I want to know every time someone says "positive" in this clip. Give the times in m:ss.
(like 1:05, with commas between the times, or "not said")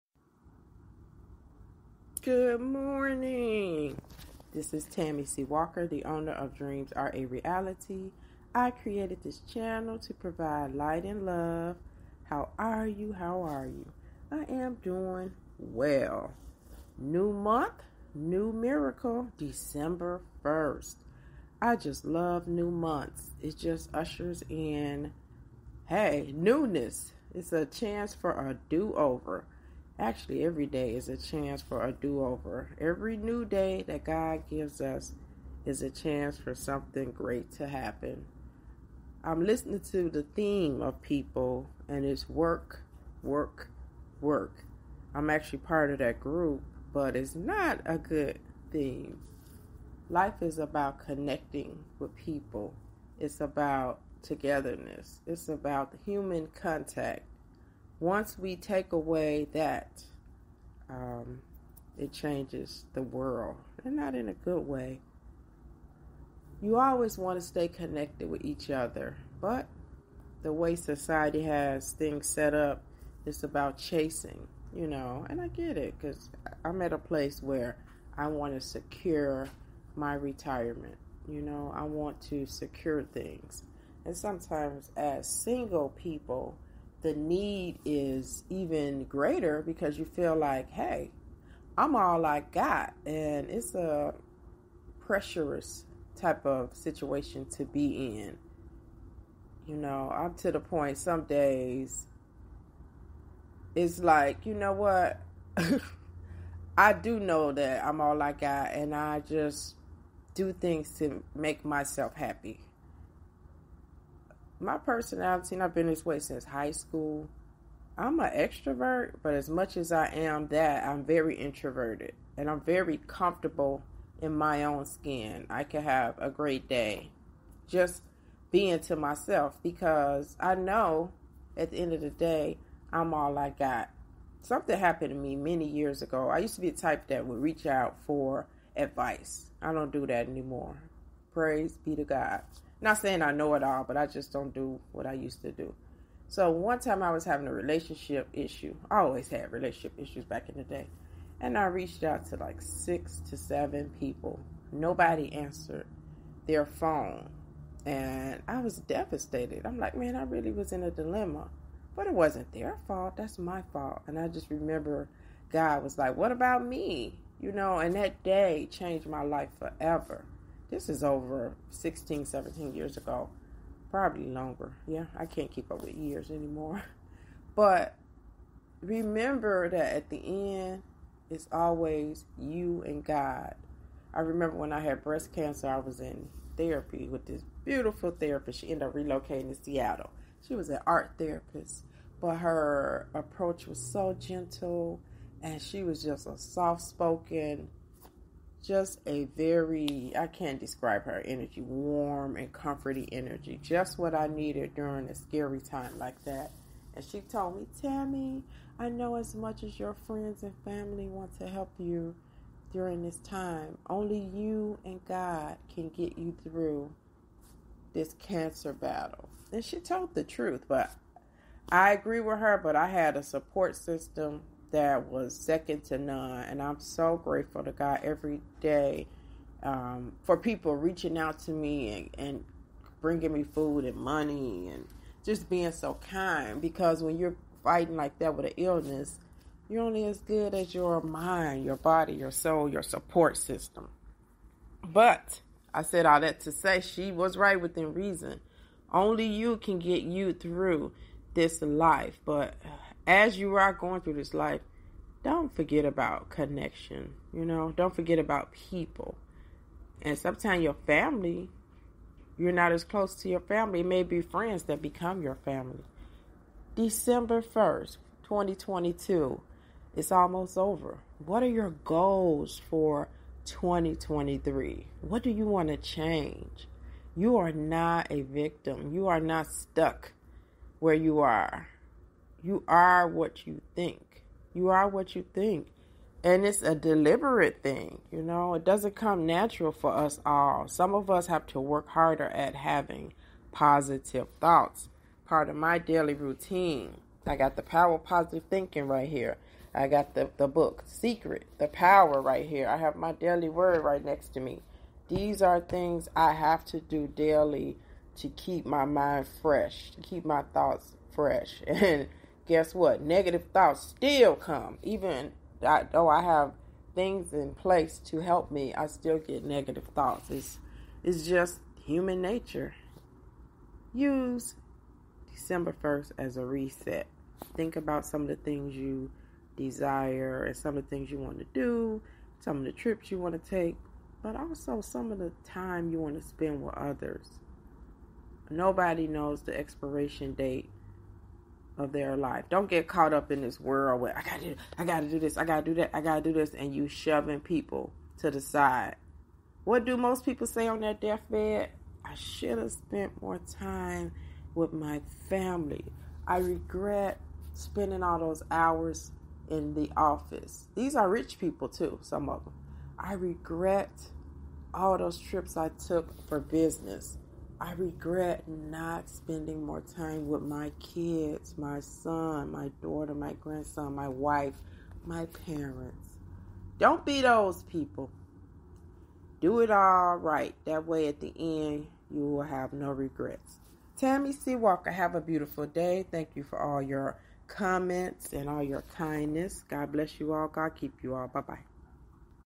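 4:53, 4:58.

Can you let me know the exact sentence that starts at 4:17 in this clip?
You know, don't forget about people.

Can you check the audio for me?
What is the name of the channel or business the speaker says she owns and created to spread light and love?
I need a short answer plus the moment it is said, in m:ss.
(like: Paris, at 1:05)
Dreams Are a Reality, at 0:06.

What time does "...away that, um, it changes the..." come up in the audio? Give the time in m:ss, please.
0:58.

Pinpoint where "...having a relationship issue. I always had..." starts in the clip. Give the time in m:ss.
2:27.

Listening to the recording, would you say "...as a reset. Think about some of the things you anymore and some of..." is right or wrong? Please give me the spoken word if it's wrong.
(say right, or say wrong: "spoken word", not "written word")
wrong: "desire", not "anymore".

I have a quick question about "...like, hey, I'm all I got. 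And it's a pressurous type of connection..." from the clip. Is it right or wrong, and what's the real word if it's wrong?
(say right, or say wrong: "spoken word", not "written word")
wrong: "situation", not "connection".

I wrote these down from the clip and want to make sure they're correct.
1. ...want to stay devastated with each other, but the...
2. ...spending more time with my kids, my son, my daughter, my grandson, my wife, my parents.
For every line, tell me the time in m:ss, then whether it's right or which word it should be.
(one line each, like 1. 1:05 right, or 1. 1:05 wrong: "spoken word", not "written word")
1. 1:07 wrong: "connected", not "devastated"
2. 6:09 right.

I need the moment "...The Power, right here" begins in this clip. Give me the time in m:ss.
5:01.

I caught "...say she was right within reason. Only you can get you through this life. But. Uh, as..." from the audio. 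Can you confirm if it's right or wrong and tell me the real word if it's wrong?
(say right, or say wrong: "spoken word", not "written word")
right.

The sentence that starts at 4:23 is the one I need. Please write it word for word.
It may be friends that become your family.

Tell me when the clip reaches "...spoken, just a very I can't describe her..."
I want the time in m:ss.
3:16.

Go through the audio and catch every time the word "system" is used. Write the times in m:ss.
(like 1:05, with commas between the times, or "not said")
3:43, 4:03.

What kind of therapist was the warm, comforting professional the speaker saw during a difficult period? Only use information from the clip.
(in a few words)
Art therapist.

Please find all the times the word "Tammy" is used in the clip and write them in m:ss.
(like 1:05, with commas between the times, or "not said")
0:04, 3:27, 6:23.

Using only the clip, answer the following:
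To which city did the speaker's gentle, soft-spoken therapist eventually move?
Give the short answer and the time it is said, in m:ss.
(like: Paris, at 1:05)
Seattle, at 3:09.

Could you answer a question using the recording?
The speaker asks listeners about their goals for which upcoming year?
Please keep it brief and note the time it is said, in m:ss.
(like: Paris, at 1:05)
2023, at 4:33.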